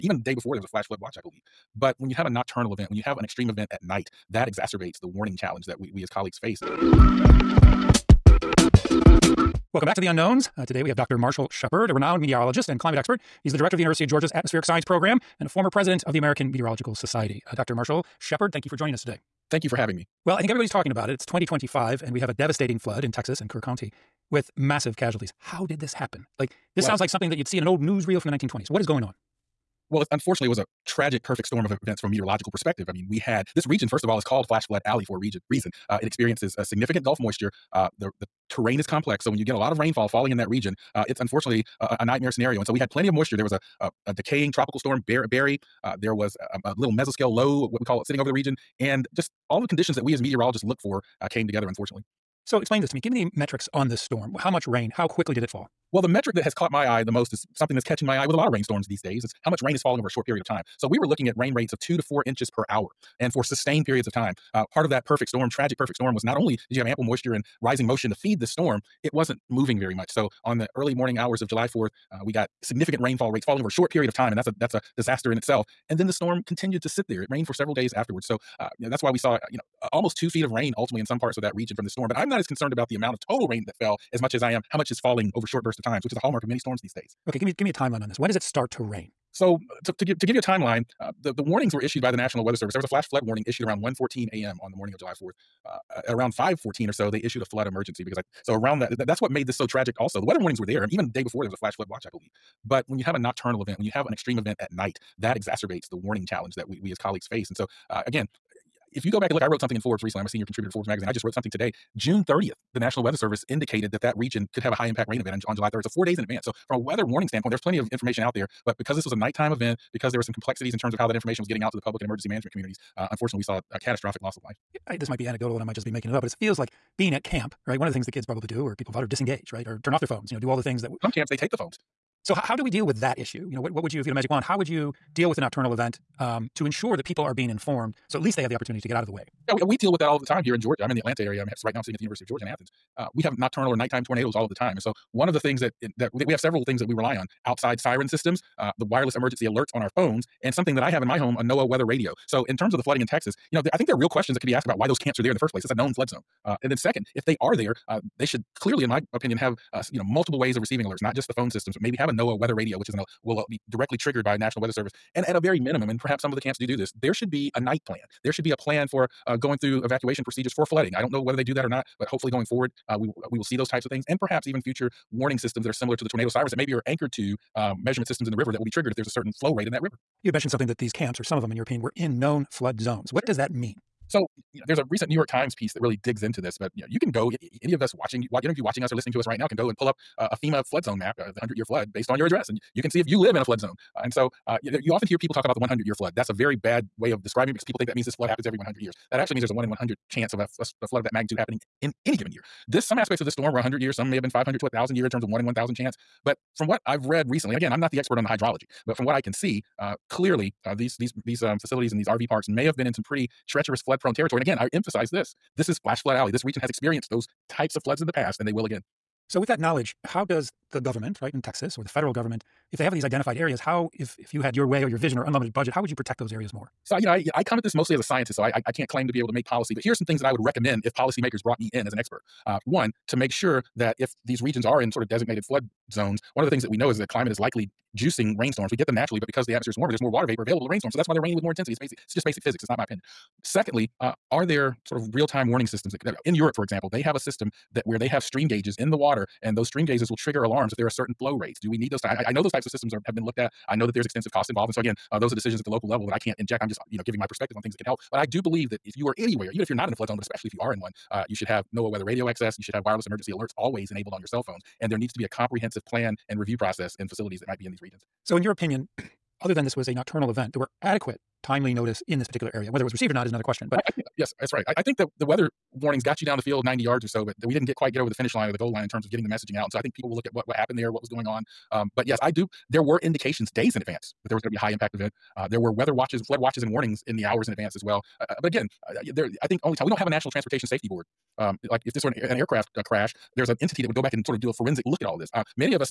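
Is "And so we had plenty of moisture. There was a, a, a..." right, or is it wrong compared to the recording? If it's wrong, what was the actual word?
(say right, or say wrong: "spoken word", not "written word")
right.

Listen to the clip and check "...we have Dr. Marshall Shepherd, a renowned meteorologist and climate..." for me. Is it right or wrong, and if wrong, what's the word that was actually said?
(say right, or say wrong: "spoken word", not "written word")
right.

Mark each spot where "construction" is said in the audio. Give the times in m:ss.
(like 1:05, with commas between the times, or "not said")
not said.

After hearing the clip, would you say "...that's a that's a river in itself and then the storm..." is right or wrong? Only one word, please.
wrong.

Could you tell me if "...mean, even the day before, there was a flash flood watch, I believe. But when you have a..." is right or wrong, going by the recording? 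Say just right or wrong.
right.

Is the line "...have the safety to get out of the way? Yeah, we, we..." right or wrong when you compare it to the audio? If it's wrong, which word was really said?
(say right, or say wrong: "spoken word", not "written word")
wrong: "opportunity", not "safety".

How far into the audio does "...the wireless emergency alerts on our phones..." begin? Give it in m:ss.
2:28.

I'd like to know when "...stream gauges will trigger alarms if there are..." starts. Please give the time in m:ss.
4:09.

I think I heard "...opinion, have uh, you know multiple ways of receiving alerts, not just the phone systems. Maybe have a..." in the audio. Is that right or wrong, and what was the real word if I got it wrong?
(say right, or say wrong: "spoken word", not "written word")
right.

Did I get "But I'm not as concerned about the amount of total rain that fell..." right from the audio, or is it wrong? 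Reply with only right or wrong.
right.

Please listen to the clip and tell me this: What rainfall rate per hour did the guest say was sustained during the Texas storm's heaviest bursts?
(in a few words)
2 to 4 inches per hour.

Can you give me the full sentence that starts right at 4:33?
But I, I yes, that's right.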